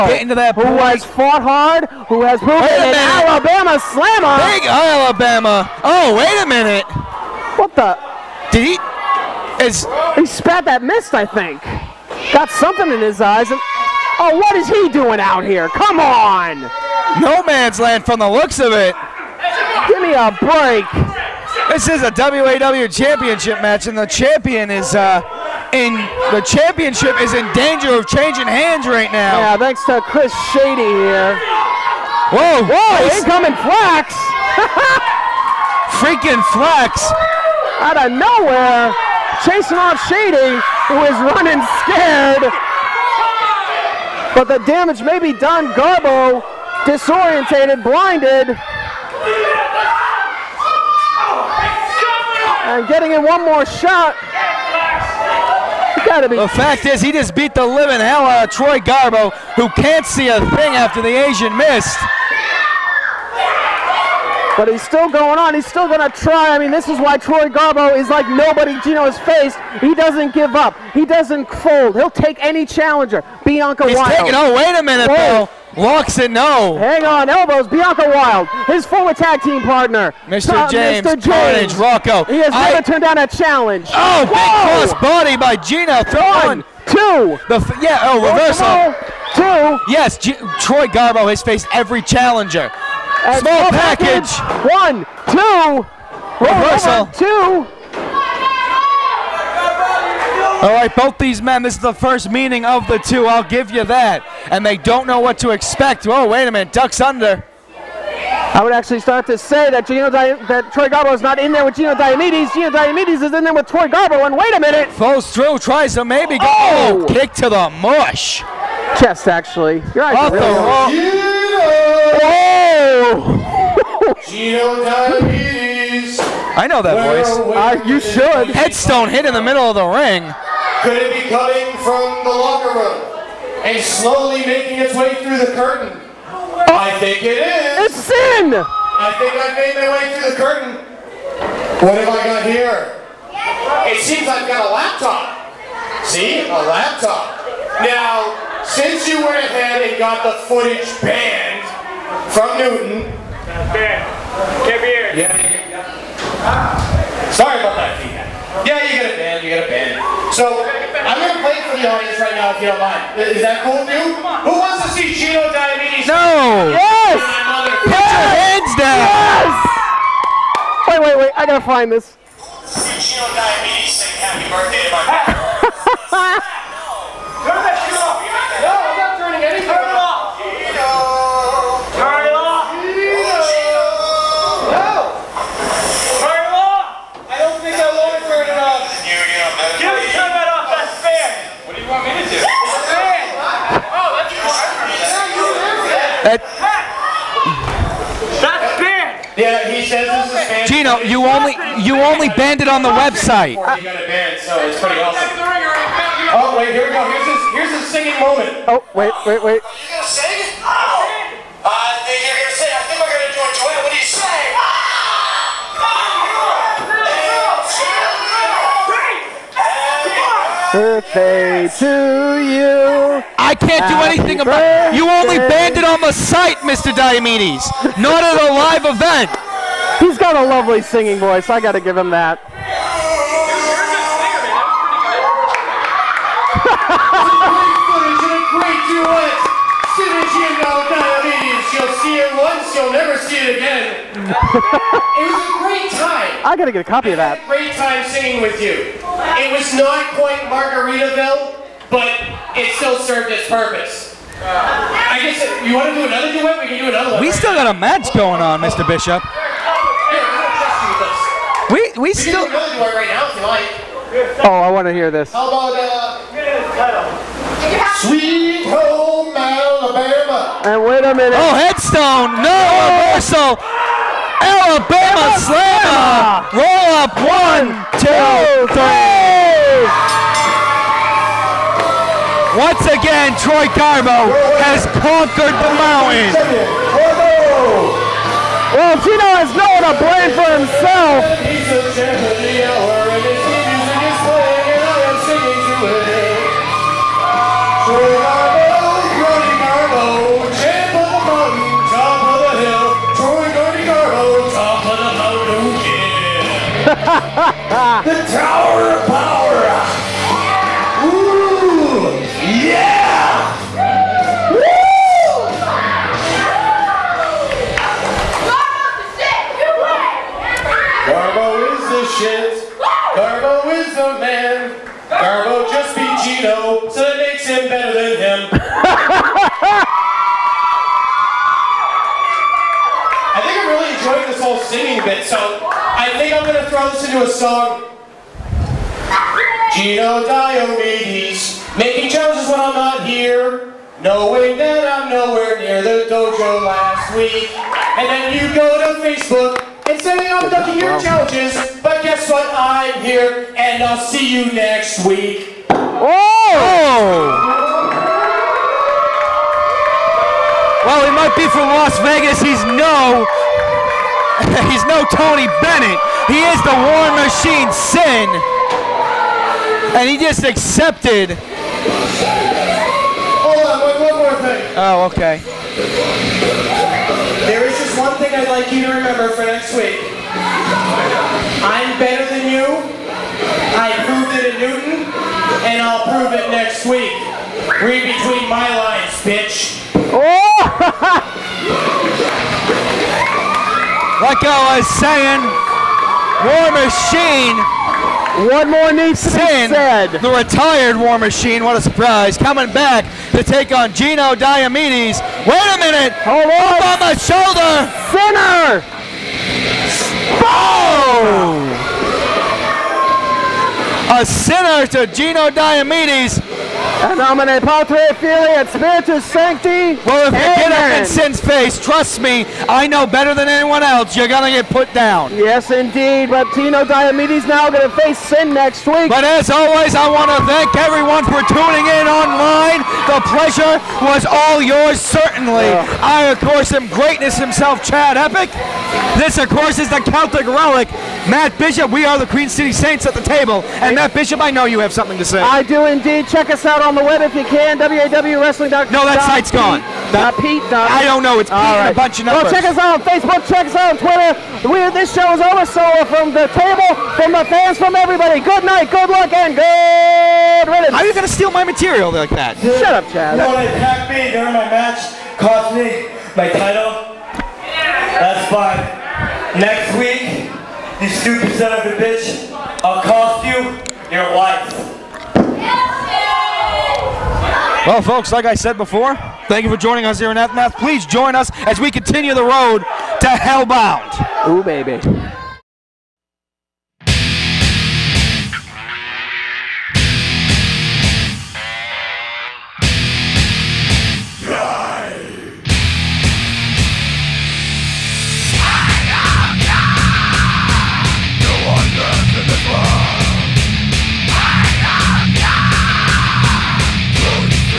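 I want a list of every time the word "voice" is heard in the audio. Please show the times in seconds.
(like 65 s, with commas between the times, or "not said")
127 s, 231 s.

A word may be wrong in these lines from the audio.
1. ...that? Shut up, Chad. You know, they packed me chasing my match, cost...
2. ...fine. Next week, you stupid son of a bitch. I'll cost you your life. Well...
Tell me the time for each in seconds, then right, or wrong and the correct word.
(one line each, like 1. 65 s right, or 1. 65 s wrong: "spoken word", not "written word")
1. 462 s wrong: "during", not "chasing"
2. 468 s right.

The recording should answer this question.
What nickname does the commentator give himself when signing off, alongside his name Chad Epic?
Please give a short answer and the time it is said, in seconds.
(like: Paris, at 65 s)
Greatness himself, at 436 s.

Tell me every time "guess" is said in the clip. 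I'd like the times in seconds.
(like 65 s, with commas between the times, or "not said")
255 s, 352 s.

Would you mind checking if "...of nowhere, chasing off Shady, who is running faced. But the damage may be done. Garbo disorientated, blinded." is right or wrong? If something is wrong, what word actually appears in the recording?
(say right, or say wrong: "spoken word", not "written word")
wrong: "scared", not "faced".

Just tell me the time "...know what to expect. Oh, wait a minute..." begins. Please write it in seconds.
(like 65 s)
105 s.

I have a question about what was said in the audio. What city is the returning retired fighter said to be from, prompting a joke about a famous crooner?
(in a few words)
Las Vegas.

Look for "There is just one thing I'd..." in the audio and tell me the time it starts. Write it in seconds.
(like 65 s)
377 s.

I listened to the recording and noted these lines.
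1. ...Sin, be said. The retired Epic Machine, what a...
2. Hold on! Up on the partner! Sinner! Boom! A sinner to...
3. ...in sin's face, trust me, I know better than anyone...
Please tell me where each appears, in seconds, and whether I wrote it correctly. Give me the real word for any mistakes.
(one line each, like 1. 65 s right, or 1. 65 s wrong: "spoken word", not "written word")
1. 399 s wrong: "War", not "Epic"
2. 406 s wrong: "shoulder", not "partner"
3. 420 s right.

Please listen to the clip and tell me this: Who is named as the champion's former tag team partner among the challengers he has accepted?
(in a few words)
Bianca Wild.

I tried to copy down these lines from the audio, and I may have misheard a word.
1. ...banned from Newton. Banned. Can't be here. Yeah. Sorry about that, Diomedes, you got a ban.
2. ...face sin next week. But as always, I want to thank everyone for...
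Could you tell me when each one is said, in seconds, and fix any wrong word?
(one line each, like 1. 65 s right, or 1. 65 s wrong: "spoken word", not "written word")
1. 150 s wrong: "Yeah", not "Diomedes"
2. 427 s right.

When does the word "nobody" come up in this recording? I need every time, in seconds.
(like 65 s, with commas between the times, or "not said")
68 s.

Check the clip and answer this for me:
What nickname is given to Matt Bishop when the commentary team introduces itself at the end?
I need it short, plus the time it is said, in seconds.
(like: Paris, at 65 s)
Celtic Relic, at 440 s.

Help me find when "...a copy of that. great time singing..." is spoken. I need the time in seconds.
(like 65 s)
246 s.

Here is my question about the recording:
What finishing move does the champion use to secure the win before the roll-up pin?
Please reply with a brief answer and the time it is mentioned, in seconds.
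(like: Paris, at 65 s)
Alabama slam, at 274 s.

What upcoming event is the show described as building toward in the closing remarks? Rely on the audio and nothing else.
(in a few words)
Hellbound.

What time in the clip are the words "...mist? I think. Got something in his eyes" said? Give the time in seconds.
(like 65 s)
10 s.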